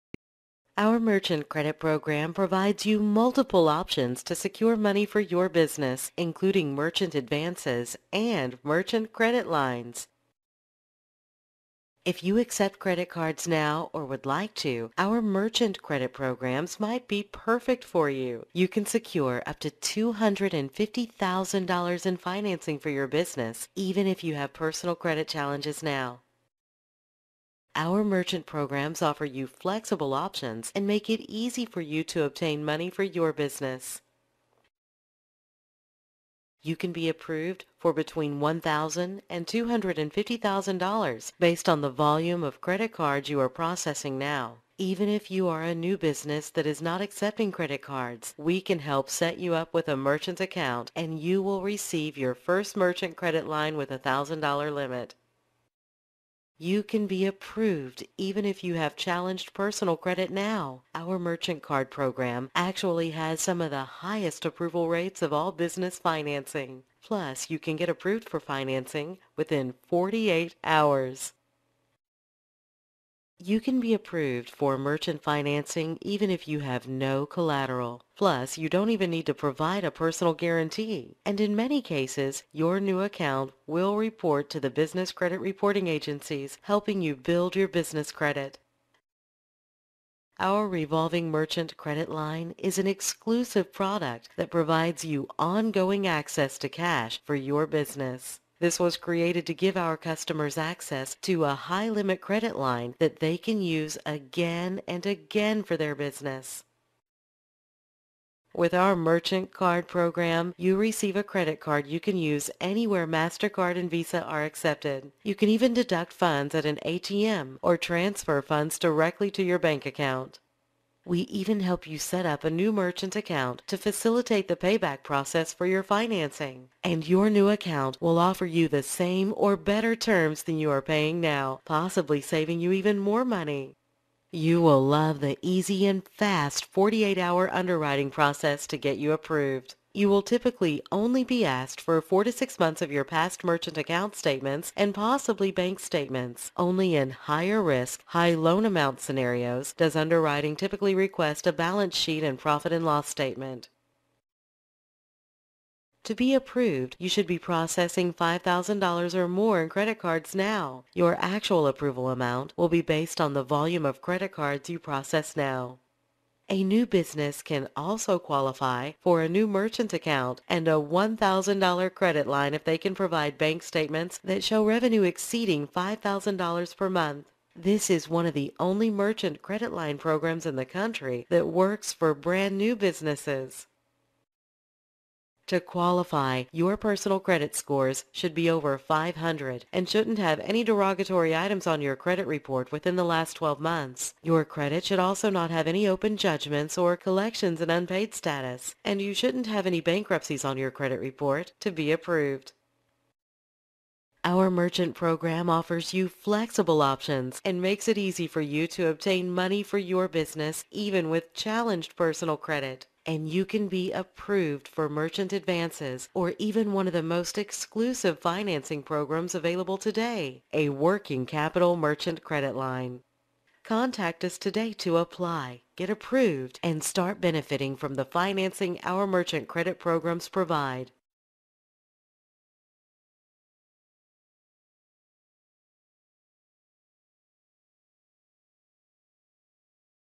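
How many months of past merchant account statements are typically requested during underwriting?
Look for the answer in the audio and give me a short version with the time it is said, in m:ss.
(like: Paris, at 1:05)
4 to 6, at 2:22.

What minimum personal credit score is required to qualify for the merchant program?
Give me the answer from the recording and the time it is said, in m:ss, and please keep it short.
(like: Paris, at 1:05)
500, at 3:08.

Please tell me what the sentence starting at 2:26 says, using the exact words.
Only in higher risk, high loan amount scenarios does underwriting typically request a balance sheet and profit and loss statement.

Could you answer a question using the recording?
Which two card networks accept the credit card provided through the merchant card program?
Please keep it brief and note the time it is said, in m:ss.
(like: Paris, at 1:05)
MasterCard and Visa, at 1:53.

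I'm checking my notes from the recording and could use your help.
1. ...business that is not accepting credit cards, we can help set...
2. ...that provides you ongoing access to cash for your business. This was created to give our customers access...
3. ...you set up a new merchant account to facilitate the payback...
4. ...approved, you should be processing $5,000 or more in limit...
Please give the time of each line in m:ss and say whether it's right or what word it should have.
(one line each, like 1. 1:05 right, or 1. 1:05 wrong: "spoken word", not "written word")
1. 0:45 right
2. 1:34 right
3. 2:01 right
4. 2:36 wrong: "credit", not "limit".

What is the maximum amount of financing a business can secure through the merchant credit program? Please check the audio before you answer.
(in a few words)
$250,000.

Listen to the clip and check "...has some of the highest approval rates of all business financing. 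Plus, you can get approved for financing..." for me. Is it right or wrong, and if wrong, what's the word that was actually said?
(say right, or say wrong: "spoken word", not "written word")
right.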